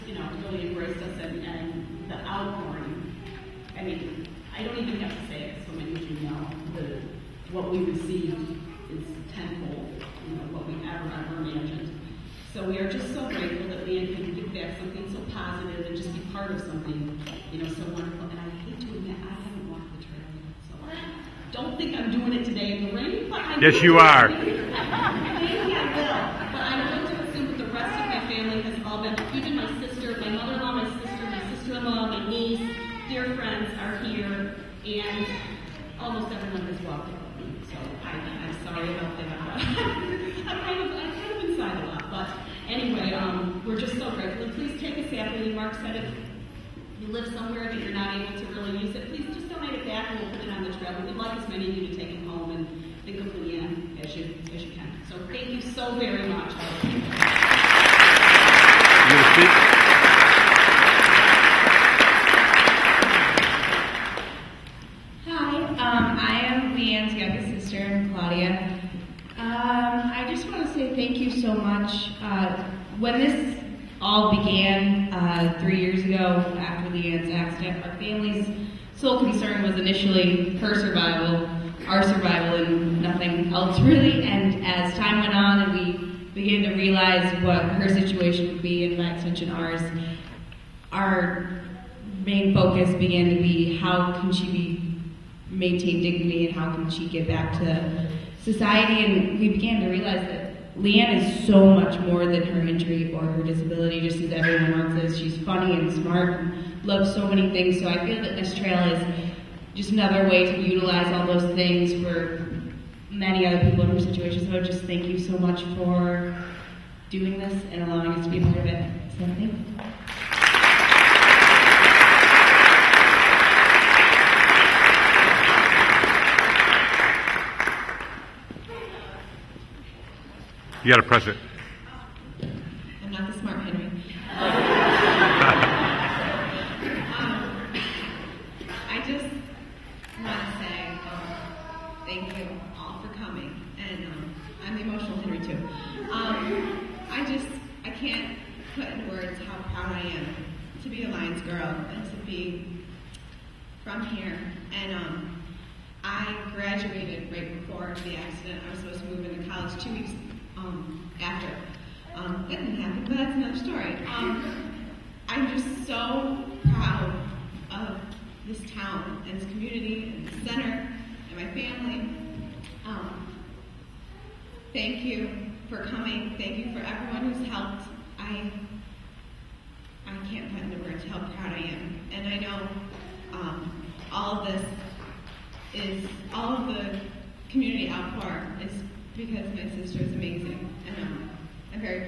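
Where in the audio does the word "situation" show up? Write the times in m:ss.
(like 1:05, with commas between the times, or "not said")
1:27, 1:53.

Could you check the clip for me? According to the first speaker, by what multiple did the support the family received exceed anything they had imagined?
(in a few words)
tenfold.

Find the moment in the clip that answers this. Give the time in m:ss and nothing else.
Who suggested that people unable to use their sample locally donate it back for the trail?
0:45.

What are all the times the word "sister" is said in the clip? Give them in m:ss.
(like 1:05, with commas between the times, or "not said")
3:09.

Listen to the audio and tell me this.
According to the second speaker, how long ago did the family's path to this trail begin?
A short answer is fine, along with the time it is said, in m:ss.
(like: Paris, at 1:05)
3 years ago, at 1:15.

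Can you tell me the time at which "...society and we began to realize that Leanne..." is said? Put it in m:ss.
1:38.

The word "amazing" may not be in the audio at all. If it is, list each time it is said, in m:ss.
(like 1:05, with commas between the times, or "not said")
3:10.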